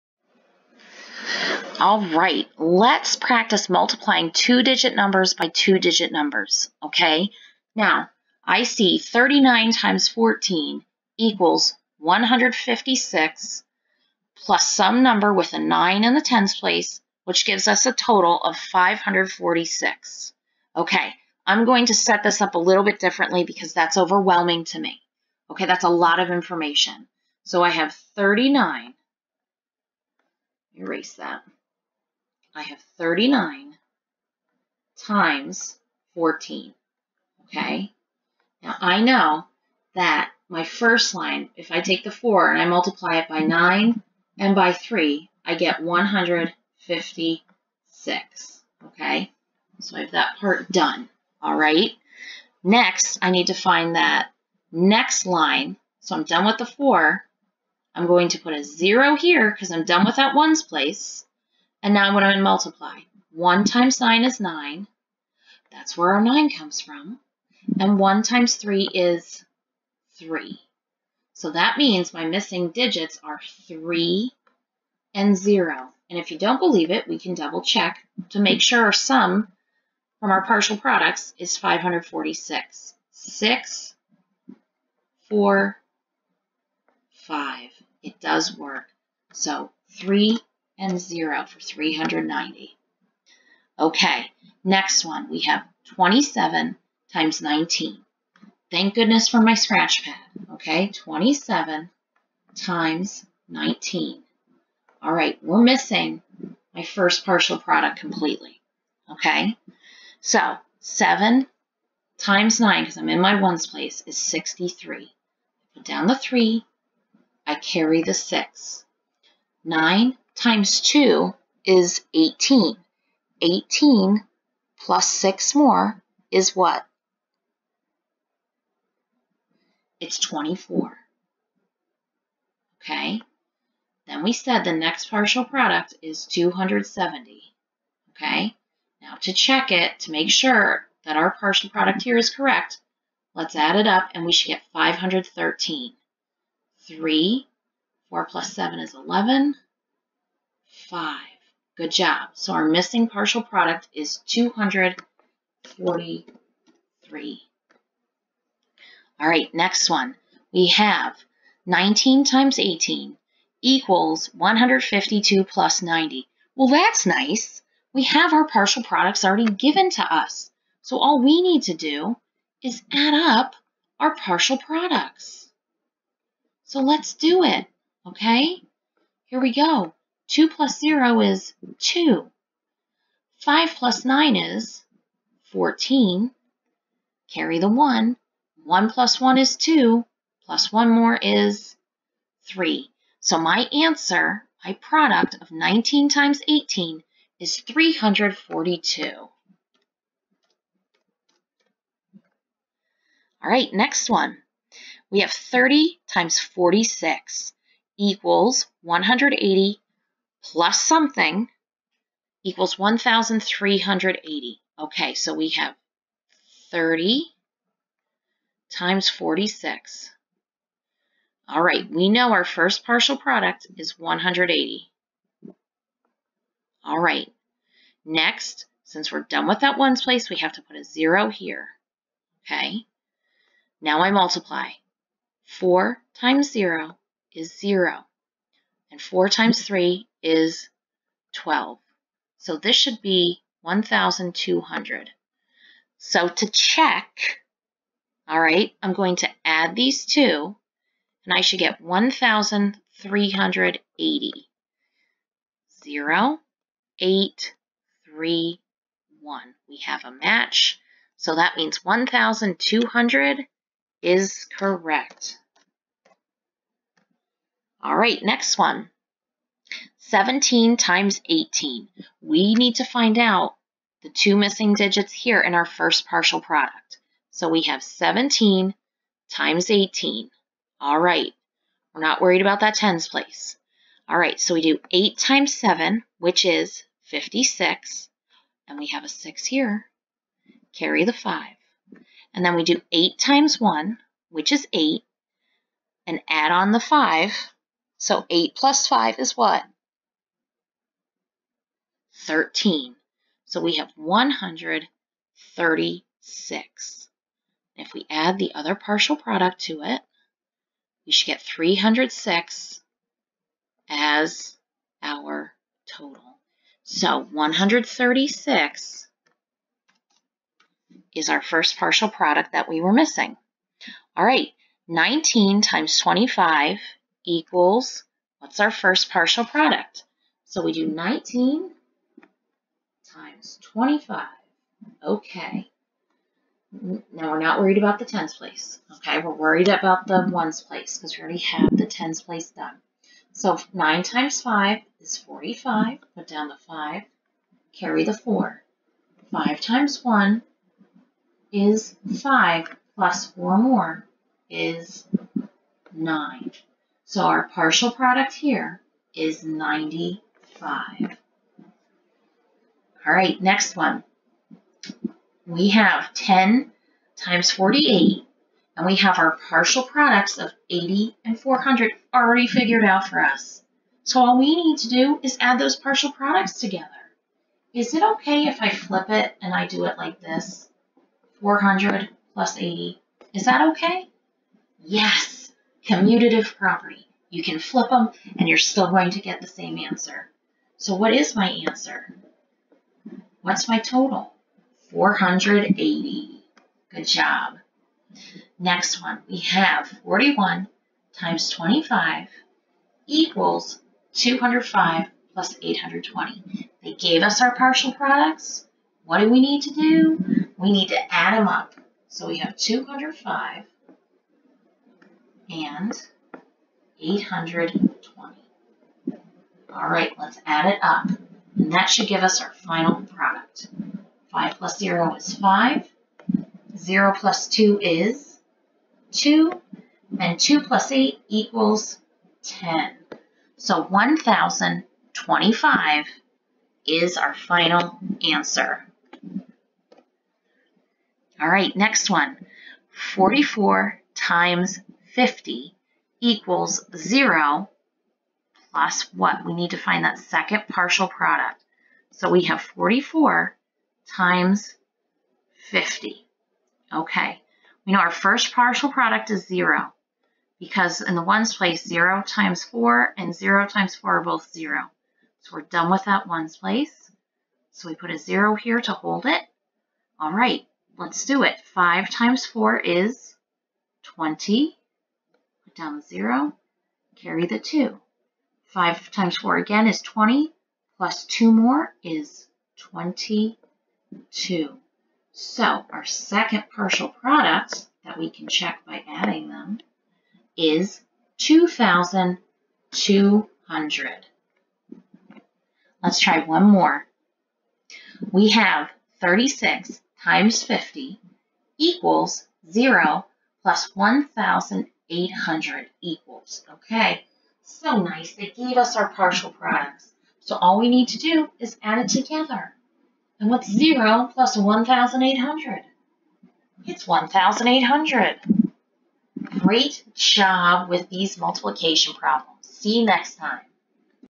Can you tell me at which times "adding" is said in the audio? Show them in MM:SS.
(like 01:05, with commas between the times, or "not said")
08:09.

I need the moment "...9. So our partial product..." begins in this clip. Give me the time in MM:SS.
05:55.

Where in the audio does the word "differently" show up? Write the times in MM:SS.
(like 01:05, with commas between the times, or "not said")
00:22.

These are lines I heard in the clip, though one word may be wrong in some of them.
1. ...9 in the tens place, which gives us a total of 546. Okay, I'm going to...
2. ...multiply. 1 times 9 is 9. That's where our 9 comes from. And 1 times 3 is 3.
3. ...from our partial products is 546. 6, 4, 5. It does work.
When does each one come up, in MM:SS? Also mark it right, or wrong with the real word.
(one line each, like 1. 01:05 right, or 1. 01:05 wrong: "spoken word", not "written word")
1. 00:15 right
2. 01:02 right
3. 01:20 right.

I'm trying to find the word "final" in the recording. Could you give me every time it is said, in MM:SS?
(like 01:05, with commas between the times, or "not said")
07:02, 07:17.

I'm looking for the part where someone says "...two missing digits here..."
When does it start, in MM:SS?
04:34.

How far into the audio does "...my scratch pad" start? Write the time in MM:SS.
01:39.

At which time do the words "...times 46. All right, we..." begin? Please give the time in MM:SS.
03:38.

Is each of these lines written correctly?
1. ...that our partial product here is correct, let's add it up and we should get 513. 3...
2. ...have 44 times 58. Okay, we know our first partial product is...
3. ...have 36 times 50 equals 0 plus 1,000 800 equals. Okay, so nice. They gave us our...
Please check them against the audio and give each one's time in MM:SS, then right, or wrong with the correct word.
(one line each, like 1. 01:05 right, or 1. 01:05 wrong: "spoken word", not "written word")
1. 02:21 right
2. 07:32 wrong: "50", not "58"
3. 08:18 right.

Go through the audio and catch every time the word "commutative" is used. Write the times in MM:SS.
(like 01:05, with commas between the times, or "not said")
06:25.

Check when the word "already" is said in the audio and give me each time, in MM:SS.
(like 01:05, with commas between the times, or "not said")
02:49, 05:41, 06:12.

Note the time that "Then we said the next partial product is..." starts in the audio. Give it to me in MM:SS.
02:14.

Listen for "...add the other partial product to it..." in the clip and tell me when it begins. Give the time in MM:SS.
05:08.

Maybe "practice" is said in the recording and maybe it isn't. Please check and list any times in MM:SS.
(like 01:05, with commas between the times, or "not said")
00:03.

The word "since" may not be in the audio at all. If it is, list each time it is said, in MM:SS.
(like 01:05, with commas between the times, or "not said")
03:48.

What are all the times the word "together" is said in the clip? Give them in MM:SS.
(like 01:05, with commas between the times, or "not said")
06:16, 08:32.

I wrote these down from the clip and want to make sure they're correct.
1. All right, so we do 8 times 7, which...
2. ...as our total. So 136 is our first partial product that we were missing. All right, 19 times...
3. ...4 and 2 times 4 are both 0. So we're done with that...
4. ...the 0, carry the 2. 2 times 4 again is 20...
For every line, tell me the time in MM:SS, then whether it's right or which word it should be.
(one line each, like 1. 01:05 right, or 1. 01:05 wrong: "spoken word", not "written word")
1. 04:44 right
2. 05:13 right
3. 07:42 wrong: "0", not "2"
4. 07:55 wrong: "5", not "2".